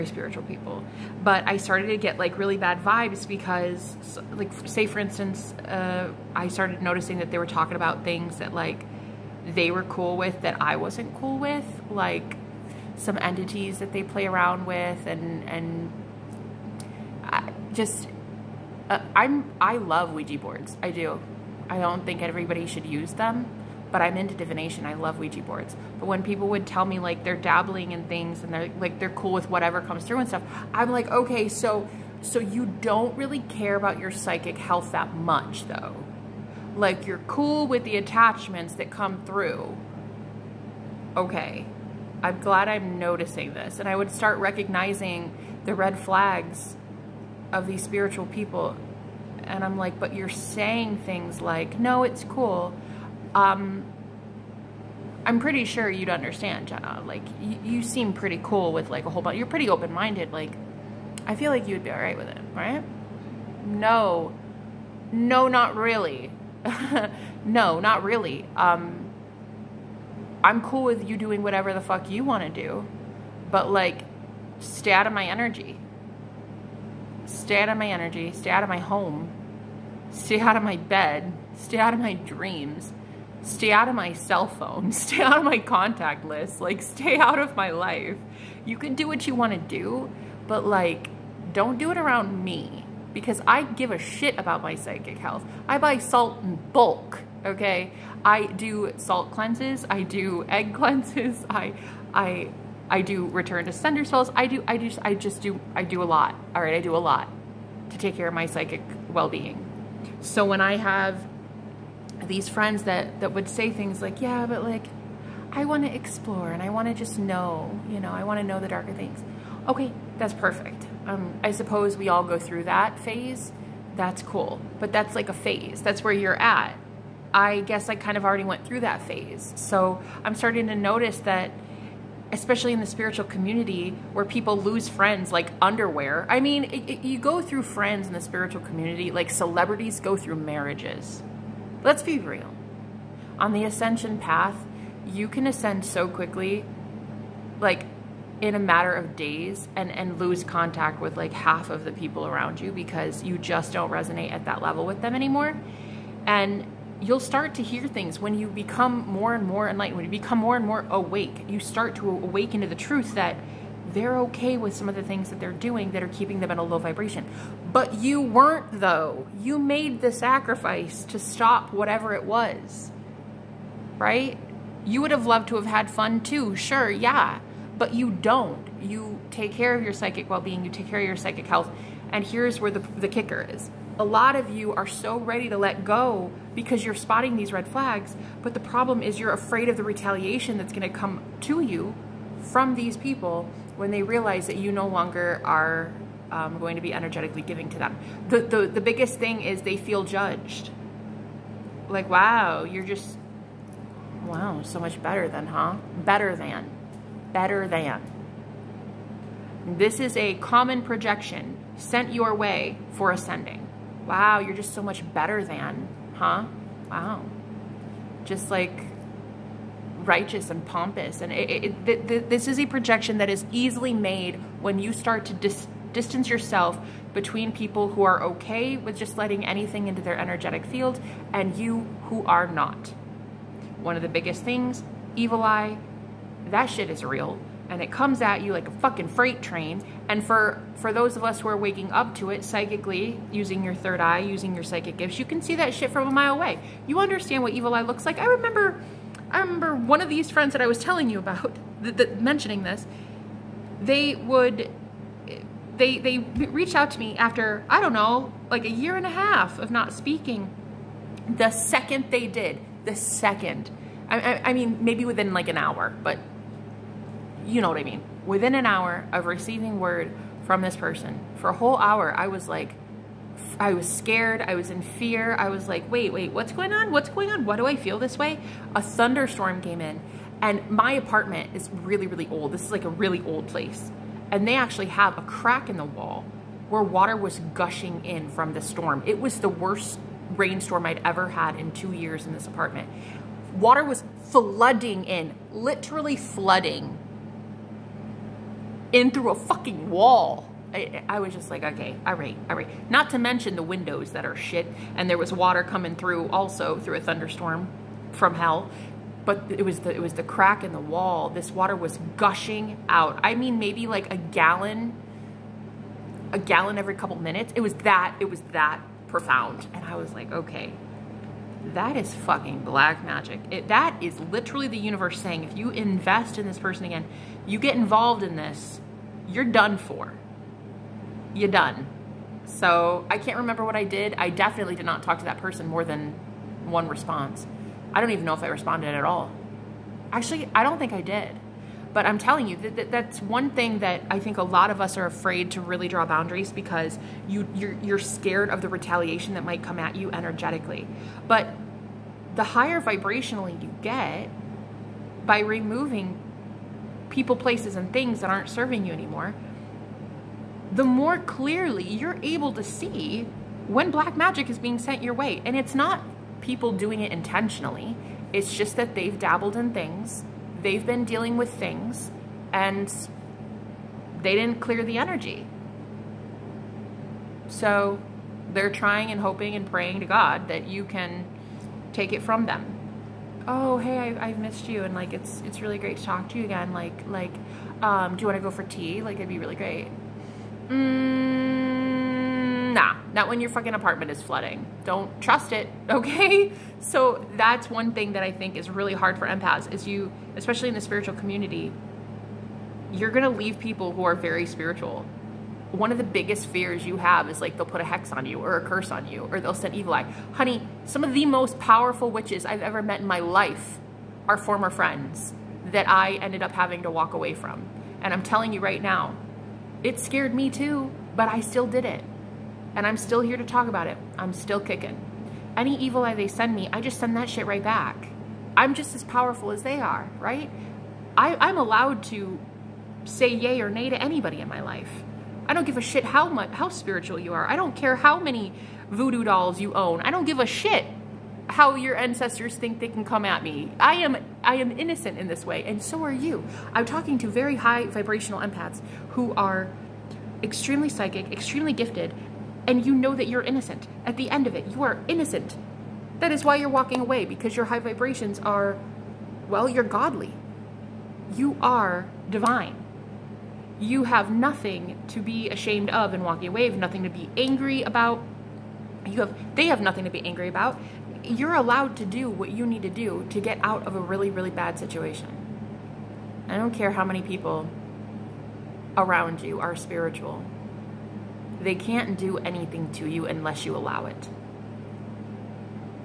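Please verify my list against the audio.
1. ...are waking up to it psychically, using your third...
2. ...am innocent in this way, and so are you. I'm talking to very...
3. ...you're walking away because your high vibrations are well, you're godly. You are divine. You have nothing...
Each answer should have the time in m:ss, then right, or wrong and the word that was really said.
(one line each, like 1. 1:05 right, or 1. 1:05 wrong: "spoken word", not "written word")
1. 4:01 right
2. 7:24 right
3. 7:36 right.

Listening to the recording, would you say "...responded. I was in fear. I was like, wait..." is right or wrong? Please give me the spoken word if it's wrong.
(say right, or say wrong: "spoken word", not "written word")
wrong: "scared", not "responded".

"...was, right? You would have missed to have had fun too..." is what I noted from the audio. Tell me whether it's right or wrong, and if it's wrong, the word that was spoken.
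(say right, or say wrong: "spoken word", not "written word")
wrong: "loved", not "missed".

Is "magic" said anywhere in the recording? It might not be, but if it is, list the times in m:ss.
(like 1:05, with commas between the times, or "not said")
5:23, 6:04.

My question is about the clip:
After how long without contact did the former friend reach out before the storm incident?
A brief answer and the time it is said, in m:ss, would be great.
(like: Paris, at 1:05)
A year and a half, at 4:18.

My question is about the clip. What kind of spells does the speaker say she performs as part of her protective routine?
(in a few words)
Return to sender spells.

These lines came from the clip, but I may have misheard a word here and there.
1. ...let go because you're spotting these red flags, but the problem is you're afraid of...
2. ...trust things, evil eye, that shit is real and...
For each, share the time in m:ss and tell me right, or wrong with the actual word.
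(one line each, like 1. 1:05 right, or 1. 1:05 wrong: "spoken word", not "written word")
1. 3:05 right
2. 3:54 wrong: "biggest", not "trust".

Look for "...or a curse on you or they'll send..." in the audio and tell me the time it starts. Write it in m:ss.
6:48.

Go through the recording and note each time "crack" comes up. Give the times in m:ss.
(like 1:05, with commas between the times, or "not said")
4:45, 5:10.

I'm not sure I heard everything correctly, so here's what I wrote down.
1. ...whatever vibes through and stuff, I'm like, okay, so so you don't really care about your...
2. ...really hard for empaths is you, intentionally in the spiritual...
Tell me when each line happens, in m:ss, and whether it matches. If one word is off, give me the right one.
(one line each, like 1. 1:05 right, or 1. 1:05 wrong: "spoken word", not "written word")
1. 0:29 wrong: "comes", not "vibes"
2. 6:38 wrong: "especially", not "intentionally".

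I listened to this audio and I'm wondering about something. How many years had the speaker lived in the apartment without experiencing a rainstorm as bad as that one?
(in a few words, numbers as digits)
2.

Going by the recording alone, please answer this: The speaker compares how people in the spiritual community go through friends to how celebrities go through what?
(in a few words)
Marriages.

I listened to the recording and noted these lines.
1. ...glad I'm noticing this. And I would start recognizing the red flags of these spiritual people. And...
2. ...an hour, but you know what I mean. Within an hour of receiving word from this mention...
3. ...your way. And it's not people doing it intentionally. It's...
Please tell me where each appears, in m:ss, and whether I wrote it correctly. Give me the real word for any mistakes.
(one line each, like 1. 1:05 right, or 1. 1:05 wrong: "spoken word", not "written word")
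1. 0:42 right
2. 4:25 wrong: "person", not "mention"
3. 6:05 right.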